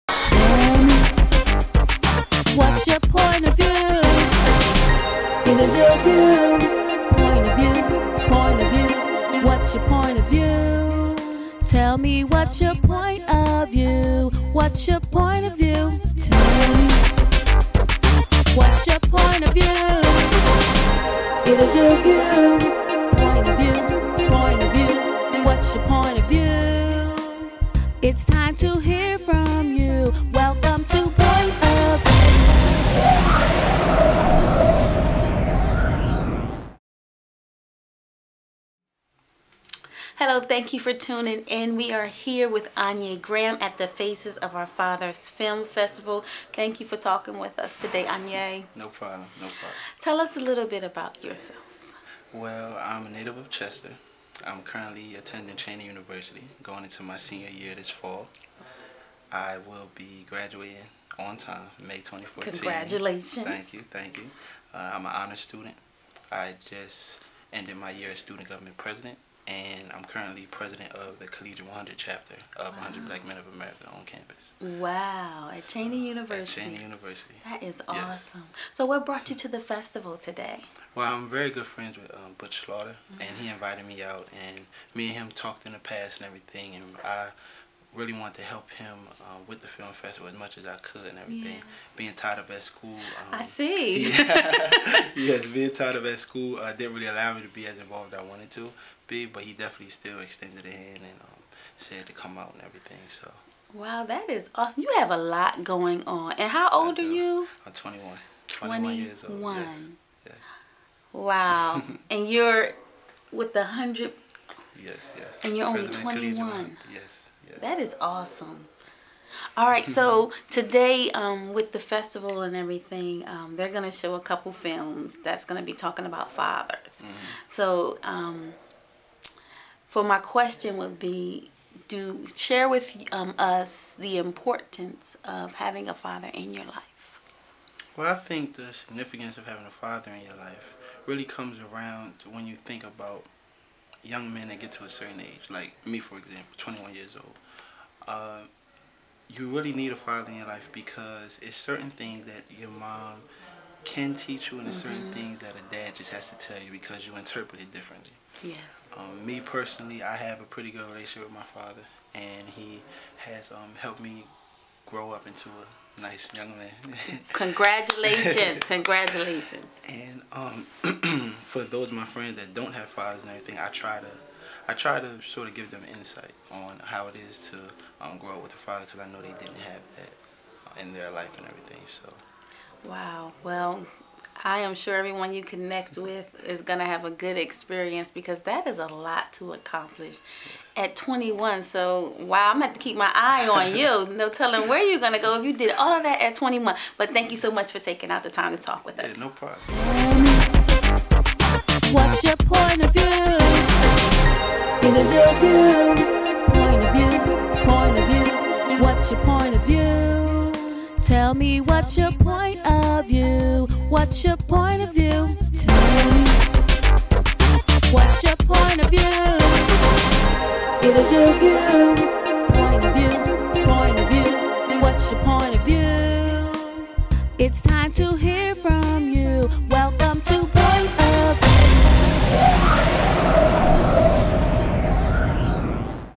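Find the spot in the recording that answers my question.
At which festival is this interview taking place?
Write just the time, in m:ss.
0:43.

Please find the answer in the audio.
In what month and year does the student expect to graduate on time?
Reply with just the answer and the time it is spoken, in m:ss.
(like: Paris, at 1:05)
May 2014, at 1:01.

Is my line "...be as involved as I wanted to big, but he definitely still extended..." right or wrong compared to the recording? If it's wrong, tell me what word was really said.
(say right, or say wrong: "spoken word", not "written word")
right.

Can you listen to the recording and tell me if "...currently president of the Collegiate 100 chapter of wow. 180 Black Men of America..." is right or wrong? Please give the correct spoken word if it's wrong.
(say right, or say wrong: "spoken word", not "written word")
wrong: "100", not "180".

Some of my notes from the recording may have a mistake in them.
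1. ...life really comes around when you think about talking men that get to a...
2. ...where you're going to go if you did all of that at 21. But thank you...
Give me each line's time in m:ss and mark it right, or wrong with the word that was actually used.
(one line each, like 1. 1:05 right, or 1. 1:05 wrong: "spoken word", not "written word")
1. 2:20 wrong: "young", not "talking"
2. 3:14 right.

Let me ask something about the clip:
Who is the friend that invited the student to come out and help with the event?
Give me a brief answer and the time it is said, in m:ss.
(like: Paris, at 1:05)
Butch Slaughter, at 1:22.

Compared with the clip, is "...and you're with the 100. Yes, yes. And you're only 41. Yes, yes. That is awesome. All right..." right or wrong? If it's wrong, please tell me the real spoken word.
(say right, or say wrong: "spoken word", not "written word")
wrong: "21", not "41".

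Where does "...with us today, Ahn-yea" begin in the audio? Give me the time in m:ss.
0:47.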